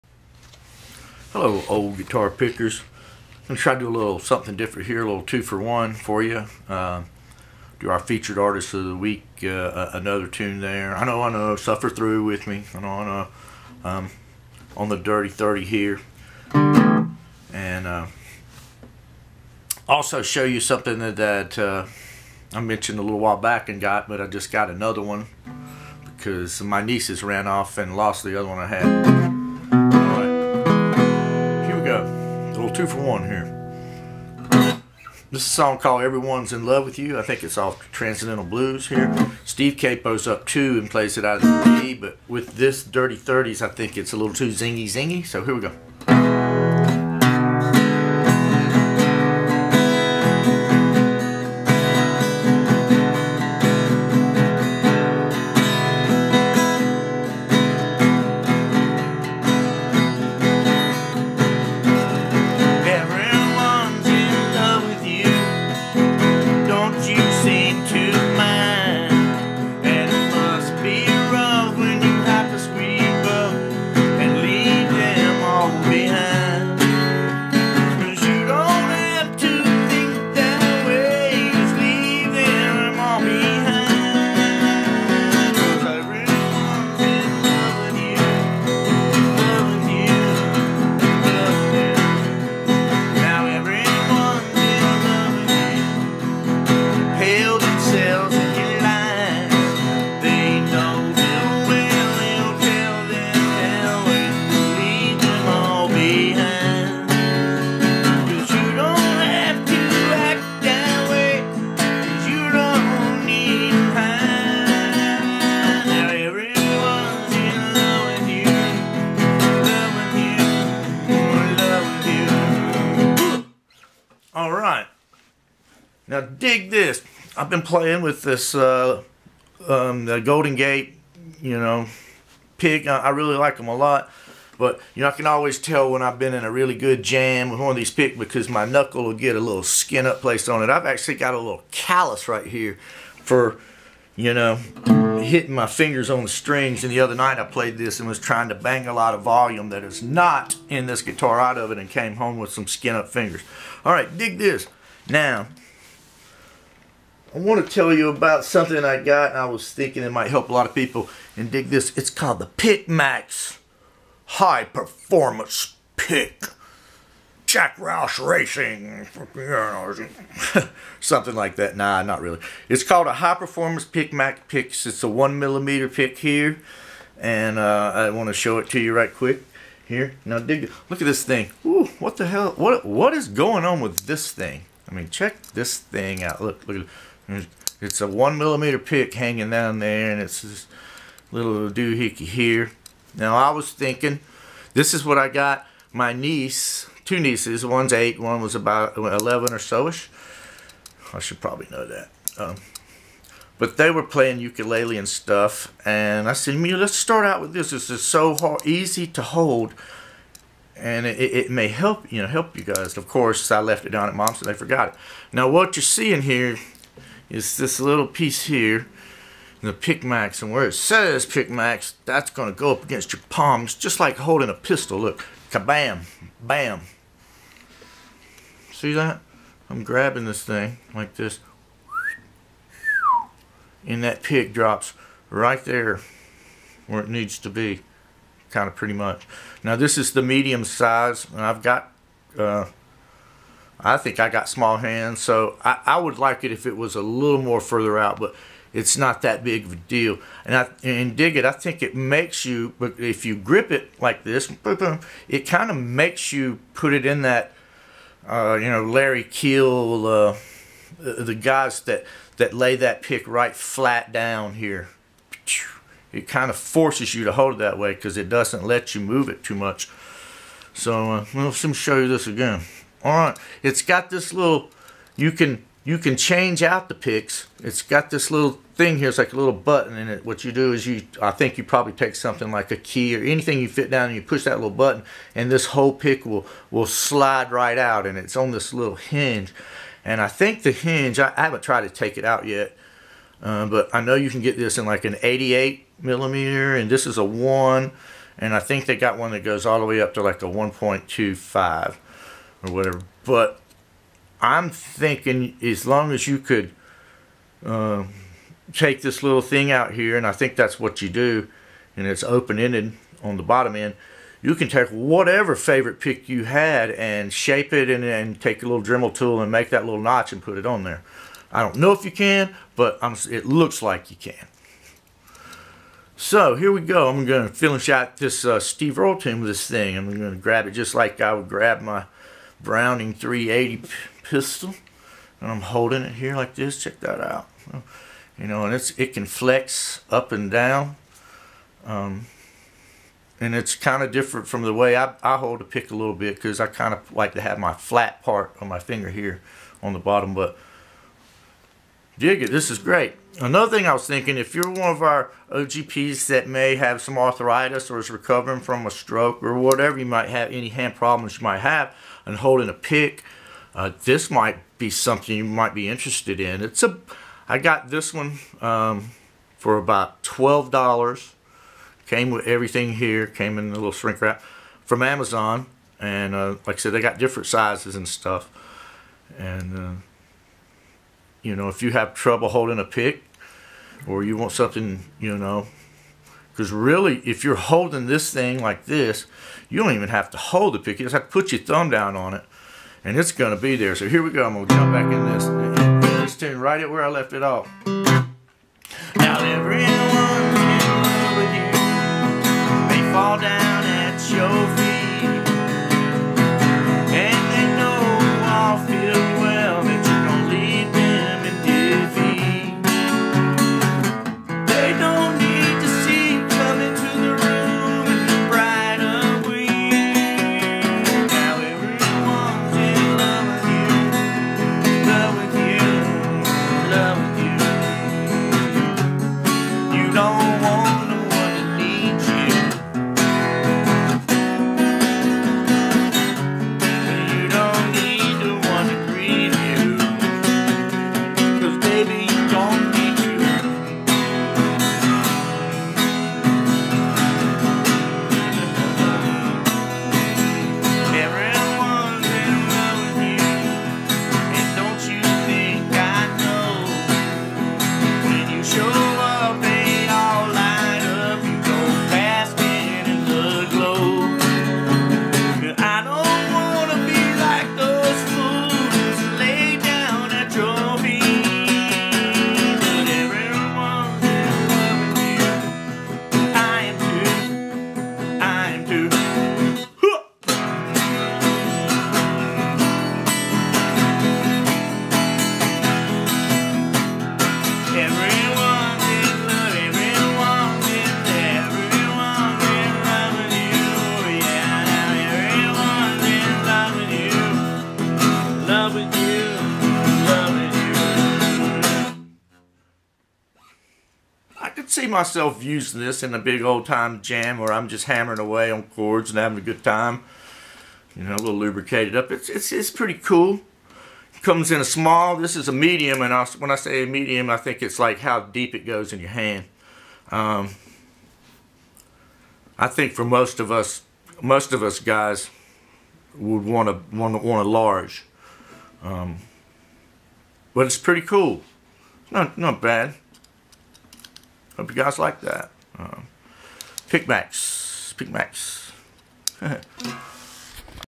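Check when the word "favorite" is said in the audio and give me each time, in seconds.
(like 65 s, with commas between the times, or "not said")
315 s.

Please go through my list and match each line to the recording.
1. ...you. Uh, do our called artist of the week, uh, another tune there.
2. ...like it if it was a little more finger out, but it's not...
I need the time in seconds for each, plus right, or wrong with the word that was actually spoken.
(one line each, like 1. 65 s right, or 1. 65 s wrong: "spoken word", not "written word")
1. 6 s wrong: "featured", not "called"
2. 246 s wrong: "further", not "finger".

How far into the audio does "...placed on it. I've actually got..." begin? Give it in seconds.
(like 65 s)
140 s.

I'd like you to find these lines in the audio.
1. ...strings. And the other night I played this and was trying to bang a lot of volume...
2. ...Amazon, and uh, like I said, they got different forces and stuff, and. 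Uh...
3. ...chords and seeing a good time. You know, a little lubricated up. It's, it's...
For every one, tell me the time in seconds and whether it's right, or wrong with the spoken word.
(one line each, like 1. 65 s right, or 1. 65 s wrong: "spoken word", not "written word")
1. 146 s right
2. 375 s wrong: "sizes", not "forces"
3. 508 s wrong: "having", not "seeing".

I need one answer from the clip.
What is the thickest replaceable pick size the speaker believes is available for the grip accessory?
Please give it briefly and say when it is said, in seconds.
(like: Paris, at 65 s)
1.25, at 300 s.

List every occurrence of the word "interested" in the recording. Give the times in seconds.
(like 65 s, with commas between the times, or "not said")
365 s.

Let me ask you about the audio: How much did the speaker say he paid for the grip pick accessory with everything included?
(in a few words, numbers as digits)
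$12.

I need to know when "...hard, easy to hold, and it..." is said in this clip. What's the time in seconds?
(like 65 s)
208 s.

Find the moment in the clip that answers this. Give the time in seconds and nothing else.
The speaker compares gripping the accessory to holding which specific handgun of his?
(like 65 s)
332 s.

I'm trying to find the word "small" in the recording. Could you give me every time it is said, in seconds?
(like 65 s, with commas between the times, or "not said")
244 s, 514 s.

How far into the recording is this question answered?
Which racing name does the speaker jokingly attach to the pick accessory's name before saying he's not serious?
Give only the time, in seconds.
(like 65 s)
167 s.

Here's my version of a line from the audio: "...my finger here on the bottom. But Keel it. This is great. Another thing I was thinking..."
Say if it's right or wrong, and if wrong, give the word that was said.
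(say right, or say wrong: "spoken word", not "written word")
wrong: "Dig", not "Keel".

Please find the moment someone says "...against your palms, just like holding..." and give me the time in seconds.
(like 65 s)
222 s.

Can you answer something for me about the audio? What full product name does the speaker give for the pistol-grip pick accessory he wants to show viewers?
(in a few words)
PykMax High Performance Pick.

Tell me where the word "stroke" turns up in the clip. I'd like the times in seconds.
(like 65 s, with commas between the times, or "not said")
358 s.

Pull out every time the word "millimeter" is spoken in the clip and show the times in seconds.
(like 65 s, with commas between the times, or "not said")
175 s, 188 s, 295 s.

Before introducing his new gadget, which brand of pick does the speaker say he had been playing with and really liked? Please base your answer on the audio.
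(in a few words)
Golden Gate.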